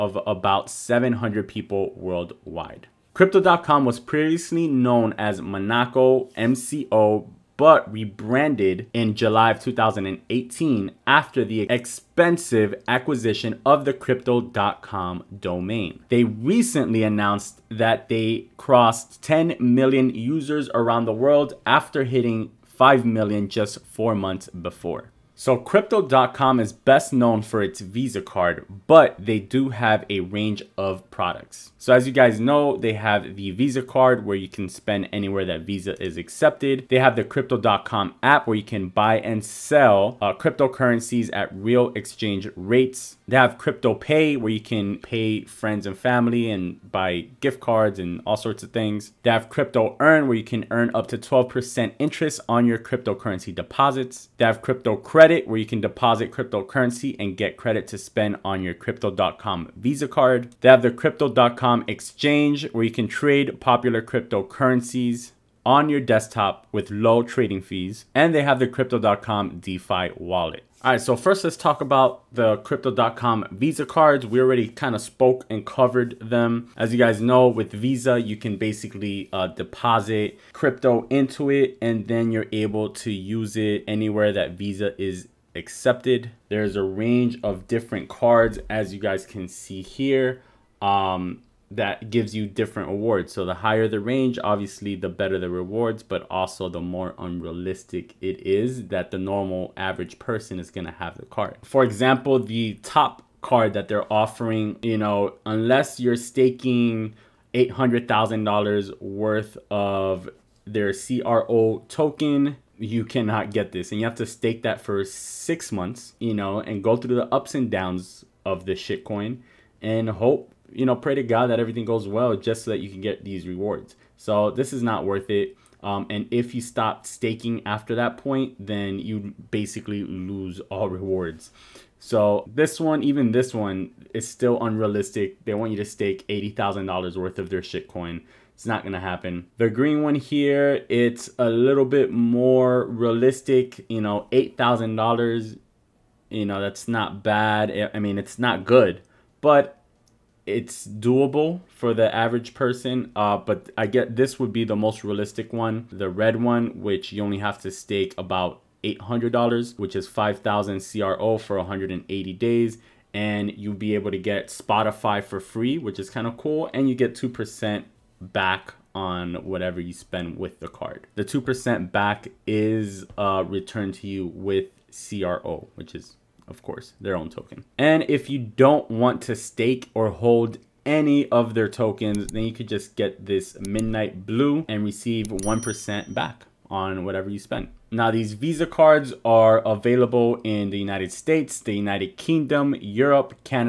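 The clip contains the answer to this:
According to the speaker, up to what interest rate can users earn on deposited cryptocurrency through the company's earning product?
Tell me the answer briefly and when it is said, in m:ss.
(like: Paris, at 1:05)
12%, at 0:51.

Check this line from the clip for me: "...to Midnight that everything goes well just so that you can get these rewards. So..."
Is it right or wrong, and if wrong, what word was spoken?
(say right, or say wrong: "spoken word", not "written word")
wrong: "God", not "Midnight".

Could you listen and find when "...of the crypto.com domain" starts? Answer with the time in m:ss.
0:13.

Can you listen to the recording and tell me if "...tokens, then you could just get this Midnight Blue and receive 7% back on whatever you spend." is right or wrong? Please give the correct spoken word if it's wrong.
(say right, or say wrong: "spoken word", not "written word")
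wrong: "1", not "7".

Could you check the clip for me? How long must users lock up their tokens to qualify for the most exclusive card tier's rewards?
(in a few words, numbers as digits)
six months.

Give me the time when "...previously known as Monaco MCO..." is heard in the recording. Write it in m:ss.
0:03.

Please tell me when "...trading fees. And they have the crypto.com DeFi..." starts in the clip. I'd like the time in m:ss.
1:07.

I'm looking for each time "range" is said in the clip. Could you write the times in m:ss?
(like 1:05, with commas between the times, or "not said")
0:30, 1:26, 1:33.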